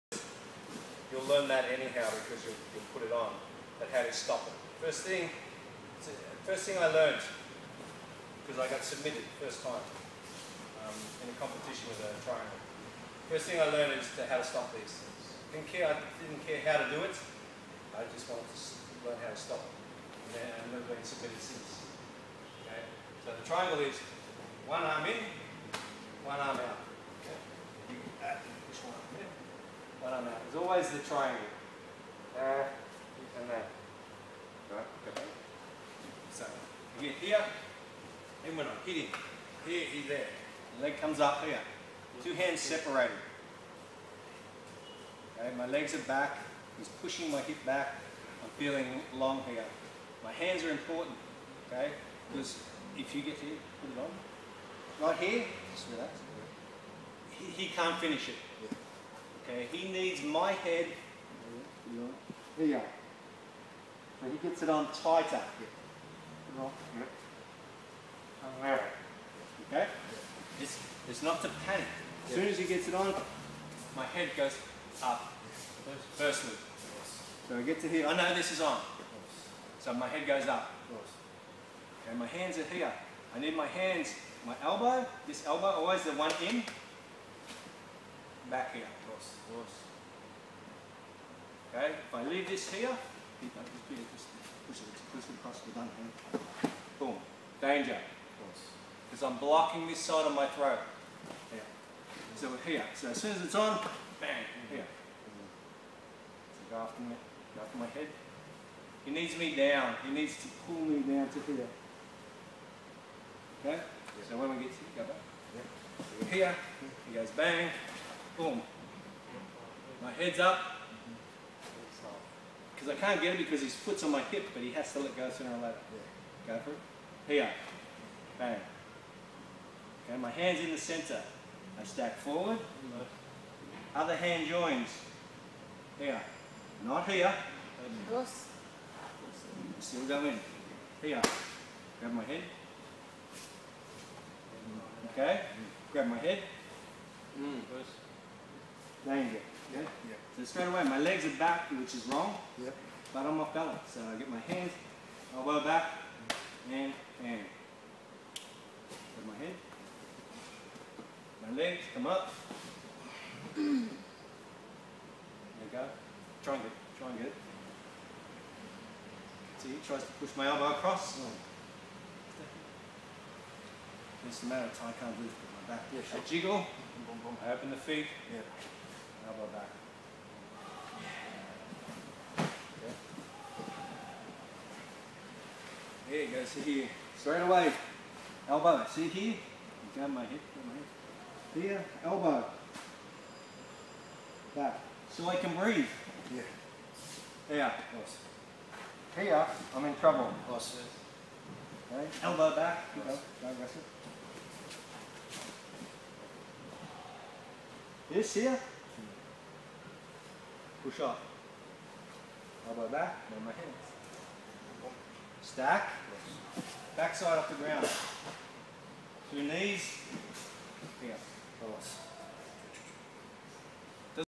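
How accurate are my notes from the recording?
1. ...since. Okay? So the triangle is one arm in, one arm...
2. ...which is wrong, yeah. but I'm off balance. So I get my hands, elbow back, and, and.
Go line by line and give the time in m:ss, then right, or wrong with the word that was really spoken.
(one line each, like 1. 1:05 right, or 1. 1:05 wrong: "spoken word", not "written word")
1. 0:21 right
2. 2:31 right.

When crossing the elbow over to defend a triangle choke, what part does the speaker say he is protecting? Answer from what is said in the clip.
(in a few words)
throat.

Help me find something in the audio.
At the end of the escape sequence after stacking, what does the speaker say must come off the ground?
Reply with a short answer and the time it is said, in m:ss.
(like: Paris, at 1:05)
Backside, at 3:36.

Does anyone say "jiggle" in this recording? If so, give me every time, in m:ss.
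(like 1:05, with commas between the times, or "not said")
2:56.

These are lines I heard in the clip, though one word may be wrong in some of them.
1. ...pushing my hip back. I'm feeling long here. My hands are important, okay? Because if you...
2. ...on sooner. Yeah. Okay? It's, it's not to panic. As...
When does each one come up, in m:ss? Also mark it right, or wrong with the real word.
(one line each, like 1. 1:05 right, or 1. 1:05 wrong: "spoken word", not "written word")
1. 0:47 right
2. 1:04 wrong: "tighter", not "sooner".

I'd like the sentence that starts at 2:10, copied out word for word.
Okay, my hand's in the center.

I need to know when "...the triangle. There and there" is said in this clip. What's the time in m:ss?
0:30.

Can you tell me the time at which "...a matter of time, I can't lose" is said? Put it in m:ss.
2:54.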